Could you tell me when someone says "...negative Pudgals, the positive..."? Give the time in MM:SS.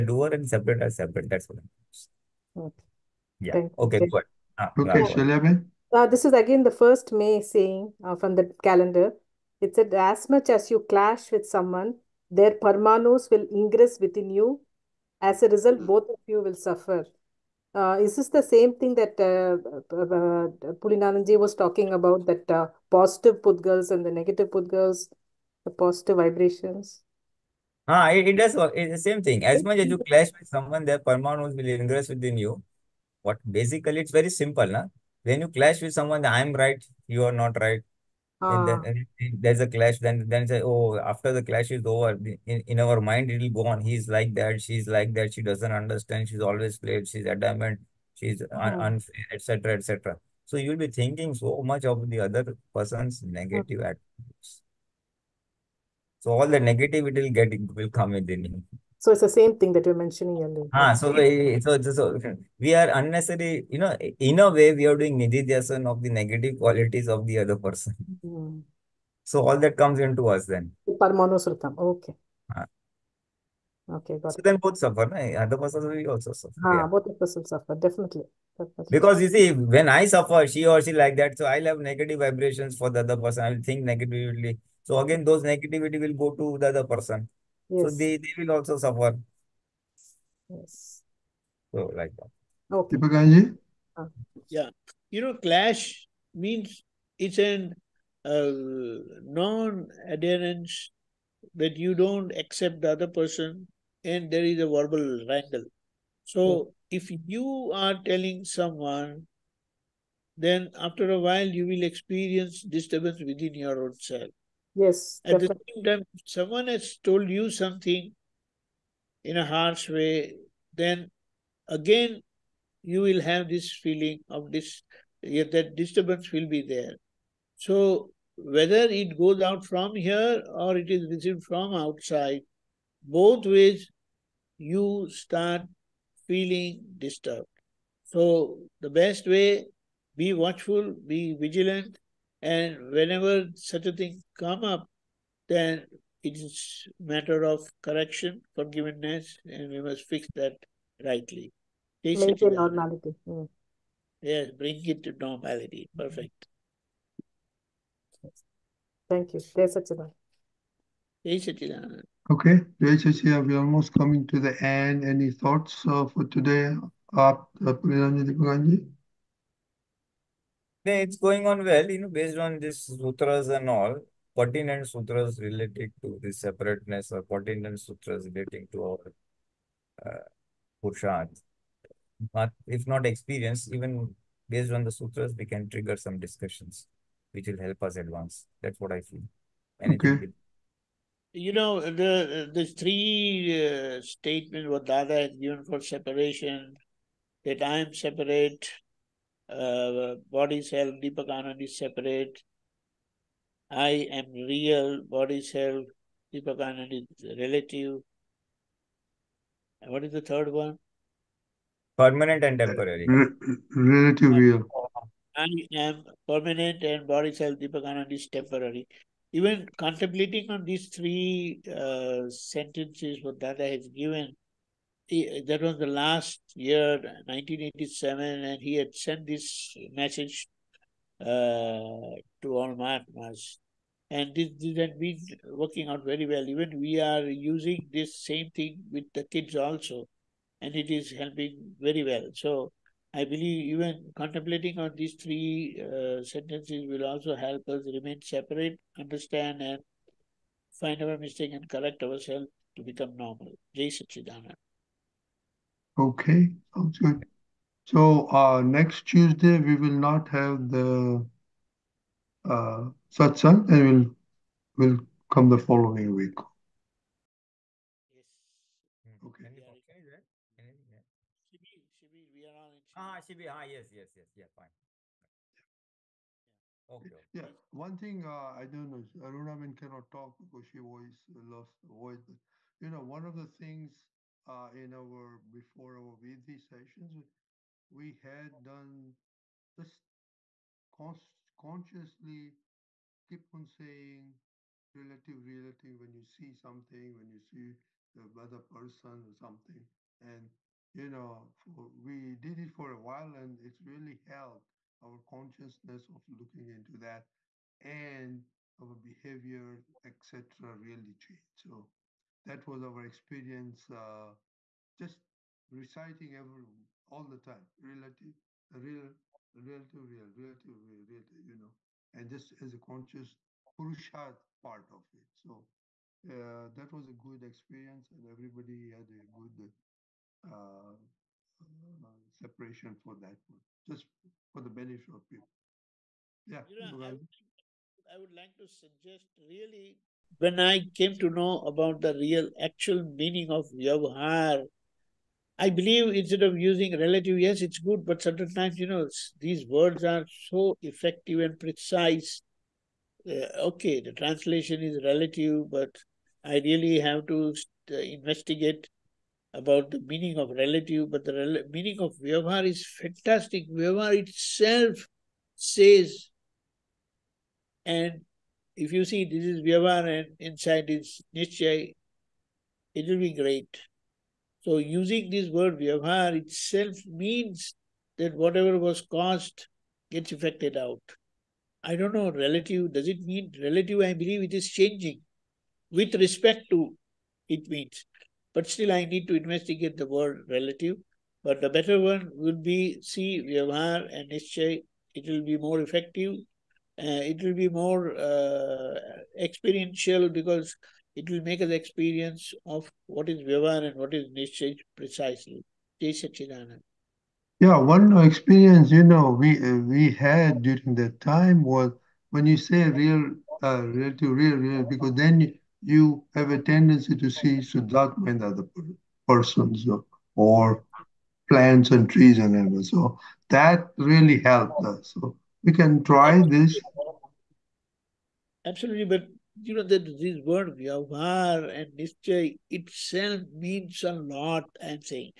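00:24.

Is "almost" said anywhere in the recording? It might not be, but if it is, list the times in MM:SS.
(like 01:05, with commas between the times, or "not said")
02:43.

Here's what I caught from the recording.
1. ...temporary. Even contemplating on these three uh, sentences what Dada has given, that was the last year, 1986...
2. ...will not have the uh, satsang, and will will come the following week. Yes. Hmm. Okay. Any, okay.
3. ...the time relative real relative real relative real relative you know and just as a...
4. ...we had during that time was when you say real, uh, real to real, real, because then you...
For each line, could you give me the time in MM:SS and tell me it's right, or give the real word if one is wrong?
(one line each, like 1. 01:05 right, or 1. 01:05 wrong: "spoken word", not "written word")
1. 03:38 wrong: "1987", not "1986"
2. 04:19 right
3. 05:17 right
4. 06:49 right.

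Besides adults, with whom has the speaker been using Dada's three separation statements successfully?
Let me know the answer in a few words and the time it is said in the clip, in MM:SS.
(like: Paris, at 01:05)
kids, at 03:59.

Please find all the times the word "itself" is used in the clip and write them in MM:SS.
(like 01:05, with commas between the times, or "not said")
06:04, 06:16, 07:12.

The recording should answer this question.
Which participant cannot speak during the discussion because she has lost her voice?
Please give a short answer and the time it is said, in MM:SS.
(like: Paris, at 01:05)
Aruna, at 04:39.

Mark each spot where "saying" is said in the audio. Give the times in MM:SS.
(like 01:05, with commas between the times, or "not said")
00:07, 04:53.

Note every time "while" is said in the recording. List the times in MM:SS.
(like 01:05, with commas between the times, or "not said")
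01:51, 05:03.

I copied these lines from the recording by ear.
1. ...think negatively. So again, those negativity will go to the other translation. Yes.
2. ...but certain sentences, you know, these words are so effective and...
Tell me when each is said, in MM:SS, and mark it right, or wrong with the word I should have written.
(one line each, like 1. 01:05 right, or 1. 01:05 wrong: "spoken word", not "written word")
1. 01:23 wrong: "person", not "translation"
2. 05:48 wrong: "times", not "sentences".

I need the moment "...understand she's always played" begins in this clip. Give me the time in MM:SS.
00:45.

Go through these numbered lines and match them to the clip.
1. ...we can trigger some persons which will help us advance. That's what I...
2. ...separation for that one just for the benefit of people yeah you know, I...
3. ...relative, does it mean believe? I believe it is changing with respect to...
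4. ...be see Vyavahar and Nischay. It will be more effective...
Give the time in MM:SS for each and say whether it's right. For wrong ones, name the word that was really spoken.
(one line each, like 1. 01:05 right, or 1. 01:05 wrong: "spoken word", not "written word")
1. 03:05 wrong: "discussions", not "persons"
2. 05:32 right
3. 06:22 wrong: "relative", not "believe"
4. 06:32 right.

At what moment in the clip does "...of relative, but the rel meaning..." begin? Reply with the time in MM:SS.
06:00.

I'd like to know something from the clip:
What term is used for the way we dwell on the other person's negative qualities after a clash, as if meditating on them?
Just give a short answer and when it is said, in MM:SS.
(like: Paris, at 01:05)
nididhyasana, at 01:05.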